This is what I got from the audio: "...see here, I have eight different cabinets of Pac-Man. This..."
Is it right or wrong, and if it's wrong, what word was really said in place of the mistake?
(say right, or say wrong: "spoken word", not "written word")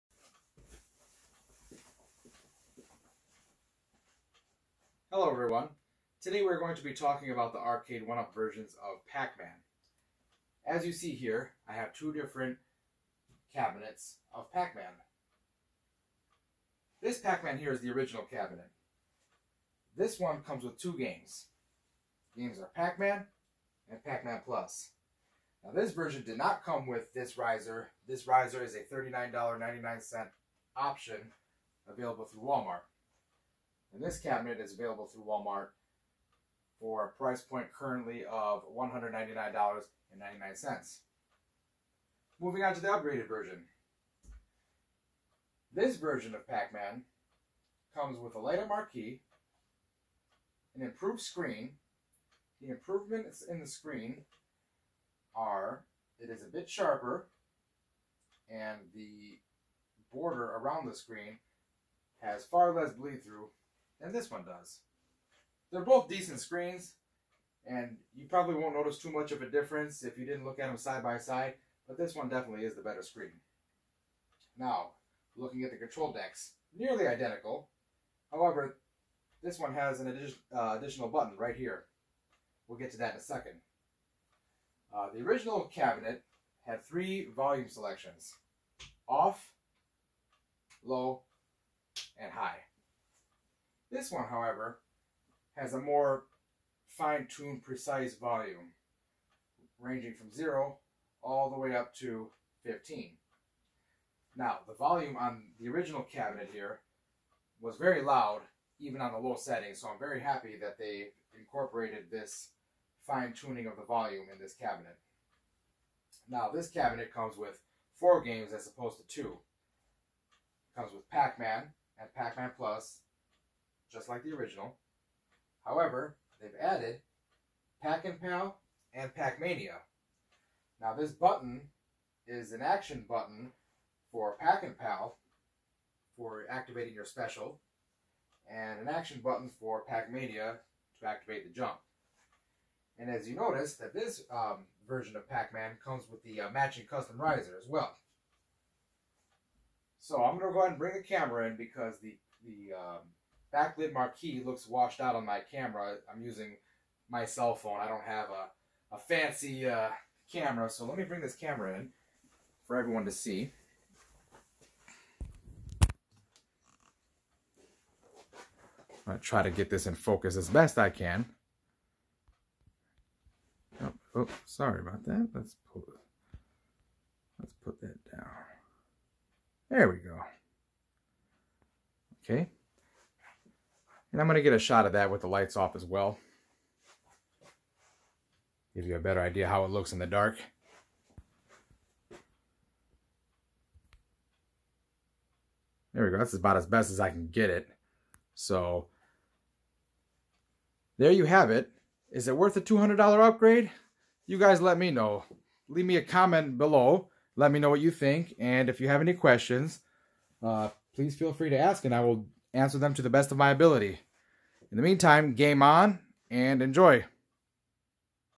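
wrong: "two", not "eight".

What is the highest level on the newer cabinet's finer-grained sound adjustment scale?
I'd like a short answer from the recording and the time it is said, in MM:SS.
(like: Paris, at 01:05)
15, at 01:42.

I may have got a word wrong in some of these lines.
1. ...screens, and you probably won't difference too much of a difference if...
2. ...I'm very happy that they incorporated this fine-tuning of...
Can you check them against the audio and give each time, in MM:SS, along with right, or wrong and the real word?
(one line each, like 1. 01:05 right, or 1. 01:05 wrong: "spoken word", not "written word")
1. 01:06 wrong: "notice", not "difference"
2. 01:49 right.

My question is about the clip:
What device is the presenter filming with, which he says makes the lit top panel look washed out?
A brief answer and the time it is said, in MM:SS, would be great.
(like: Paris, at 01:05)
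cell phone, at 02:37.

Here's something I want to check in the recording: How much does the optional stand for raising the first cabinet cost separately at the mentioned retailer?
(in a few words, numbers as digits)
$39.99.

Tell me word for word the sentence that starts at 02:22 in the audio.
And as you notice, that this um, version of Pac-Man comes with the uh, matching custom riser as well.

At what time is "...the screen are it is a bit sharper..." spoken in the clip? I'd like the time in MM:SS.
00:53.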